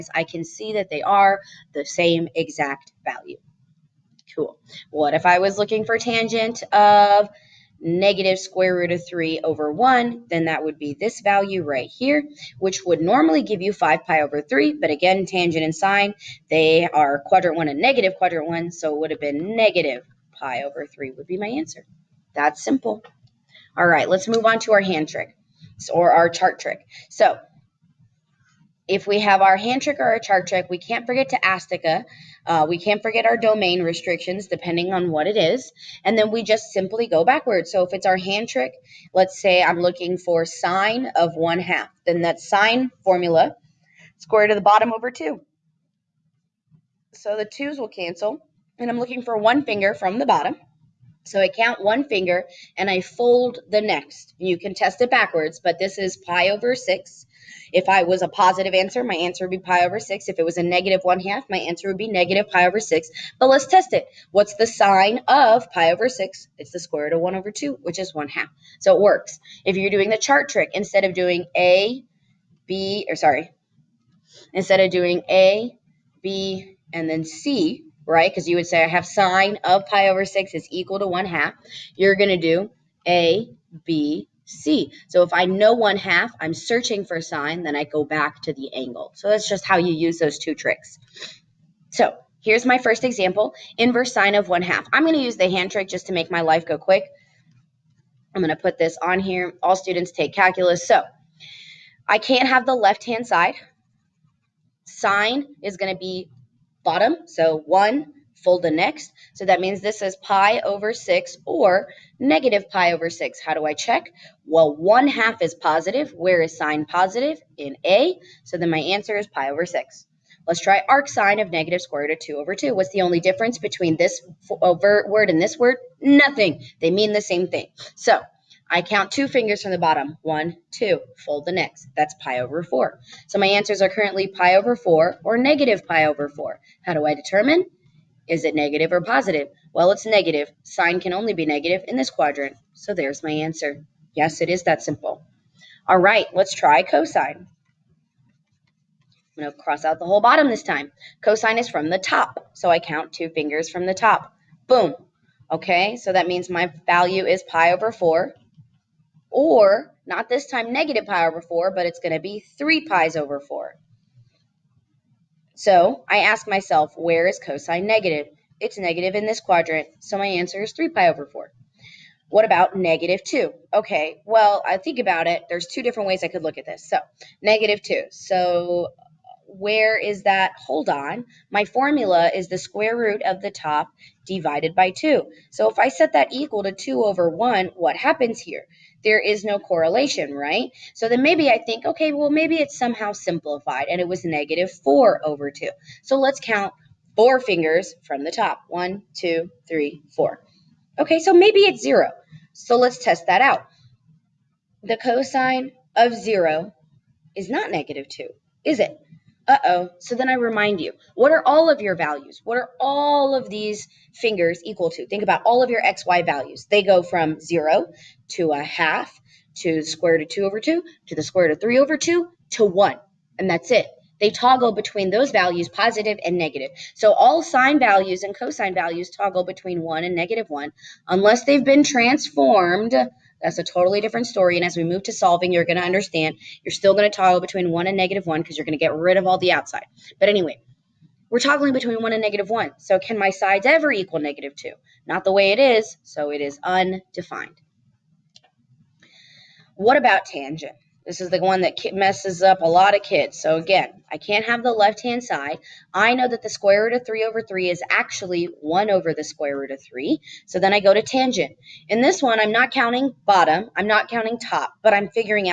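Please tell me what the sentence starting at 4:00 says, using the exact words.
But anyway, we're toggling between one and negative one.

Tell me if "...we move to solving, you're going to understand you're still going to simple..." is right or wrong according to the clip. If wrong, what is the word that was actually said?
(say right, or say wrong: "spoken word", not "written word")
wrong: "toggle", not "simple".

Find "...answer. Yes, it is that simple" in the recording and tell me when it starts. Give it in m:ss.
2:23.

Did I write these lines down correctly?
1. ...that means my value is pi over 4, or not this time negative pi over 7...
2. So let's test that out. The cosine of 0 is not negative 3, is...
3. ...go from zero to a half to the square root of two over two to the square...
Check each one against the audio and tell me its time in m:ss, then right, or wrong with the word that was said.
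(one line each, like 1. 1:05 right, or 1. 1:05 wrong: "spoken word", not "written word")
1. 2:36 wrong: "4", not "7"
2. 3:22 wrong: "2", not "3"
3. 3:36 right.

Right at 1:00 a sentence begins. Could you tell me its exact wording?
If it was a negative 1 half, my answer would be negative pi over 6.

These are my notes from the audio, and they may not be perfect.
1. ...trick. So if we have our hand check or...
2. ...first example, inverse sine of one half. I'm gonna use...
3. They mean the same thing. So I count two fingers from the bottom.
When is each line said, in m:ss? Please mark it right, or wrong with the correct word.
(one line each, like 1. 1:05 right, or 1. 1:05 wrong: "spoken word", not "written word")
1. 0:26 wrong: "trick", not "check"
2. 1:32 right
3. 2:06 right.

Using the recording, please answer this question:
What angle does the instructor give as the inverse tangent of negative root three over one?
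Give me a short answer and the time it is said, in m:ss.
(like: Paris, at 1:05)
-pi/3, at 0:19.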